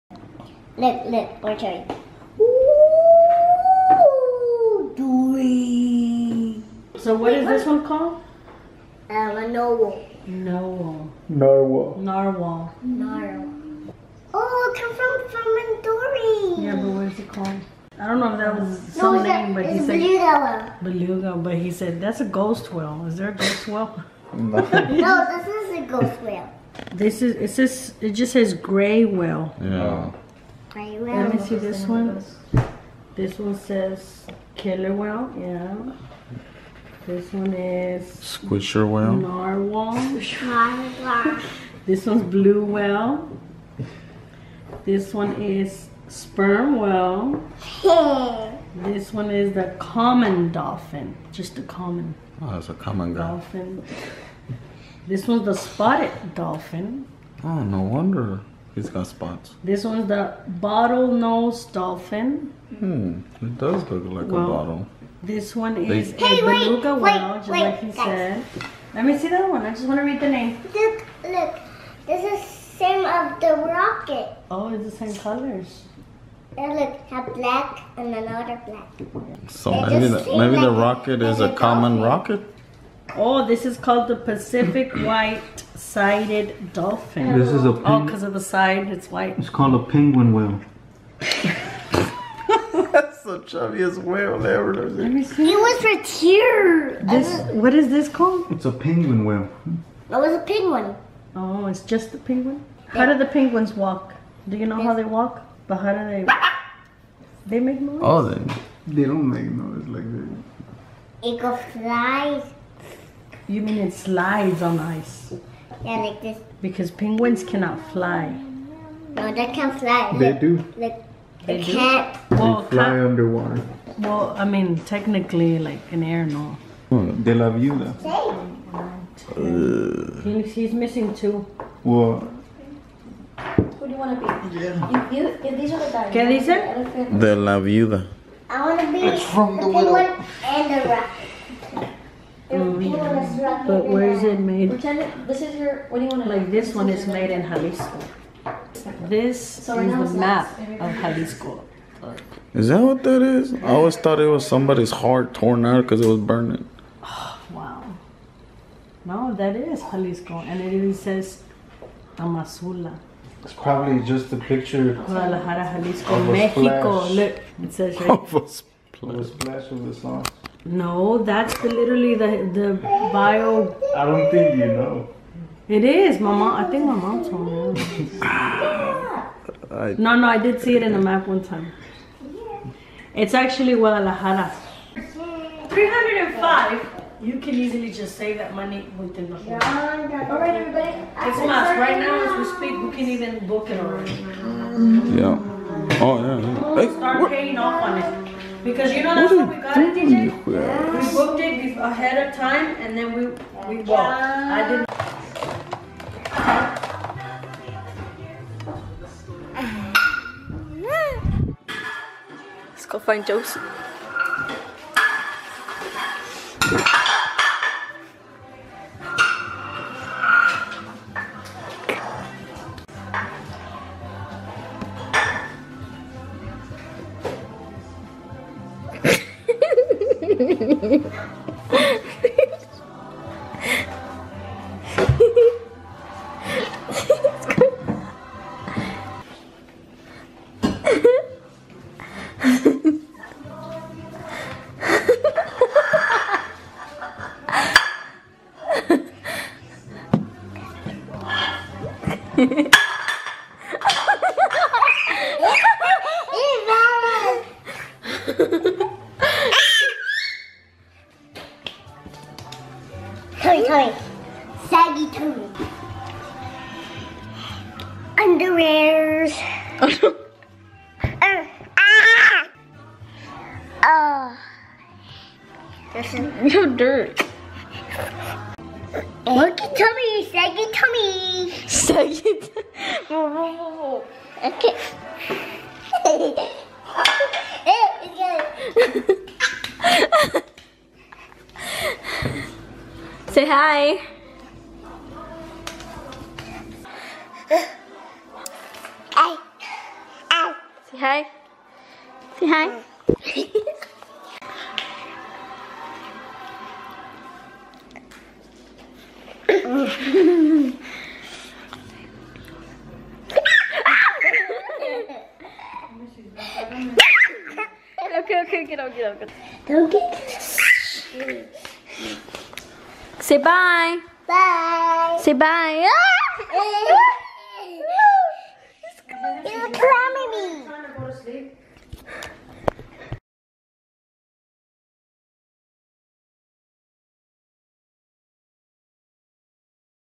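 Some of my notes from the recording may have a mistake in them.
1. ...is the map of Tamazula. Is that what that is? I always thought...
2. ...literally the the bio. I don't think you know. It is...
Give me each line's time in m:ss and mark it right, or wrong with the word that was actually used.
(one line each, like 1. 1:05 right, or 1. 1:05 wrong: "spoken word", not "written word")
1. 2:29 wrong: "Jalisco", not "Tamazula"
2. 2:51 right.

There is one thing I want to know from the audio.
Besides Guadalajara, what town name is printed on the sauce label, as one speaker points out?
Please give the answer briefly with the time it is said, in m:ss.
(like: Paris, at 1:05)
Tamazula, at 2:42.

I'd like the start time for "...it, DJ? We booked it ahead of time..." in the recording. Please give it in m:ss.
3:19.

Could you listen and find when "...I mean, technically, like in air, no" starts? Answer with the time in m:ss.
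2:04.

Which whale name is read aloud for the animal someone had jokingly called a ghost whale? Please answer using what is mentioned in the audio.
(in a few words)
gray whale.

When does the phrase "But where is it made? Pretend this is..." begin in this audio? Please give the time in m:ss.
2:22.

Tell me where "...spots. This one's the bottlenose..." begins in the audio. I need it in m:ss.
0:59.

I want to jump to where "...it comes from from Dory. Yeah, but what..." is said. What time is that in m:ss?
0:14.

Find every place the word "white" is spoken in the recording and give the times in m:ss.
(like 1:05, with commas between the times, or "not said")
1:24, 1:29.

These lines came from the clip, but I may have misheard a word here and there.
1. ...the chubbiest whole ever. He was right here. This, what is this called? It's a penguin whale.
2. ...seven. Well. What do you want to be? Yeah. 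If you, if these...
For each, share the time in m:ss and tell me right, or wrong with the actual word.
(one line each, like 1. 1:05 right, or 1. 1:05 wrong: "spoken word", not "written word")
1. 1:33 wrong: "whale", not "whole"
2. 2:11 wrong: "two", not "seven".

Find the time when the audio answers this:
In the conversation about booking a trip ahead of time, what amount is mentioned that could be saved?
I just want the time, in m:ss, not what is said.
3:05.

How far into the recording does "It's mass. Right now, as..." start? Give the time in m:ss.
3:11.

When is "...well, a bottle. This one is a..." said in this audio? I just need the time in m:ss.
1:04.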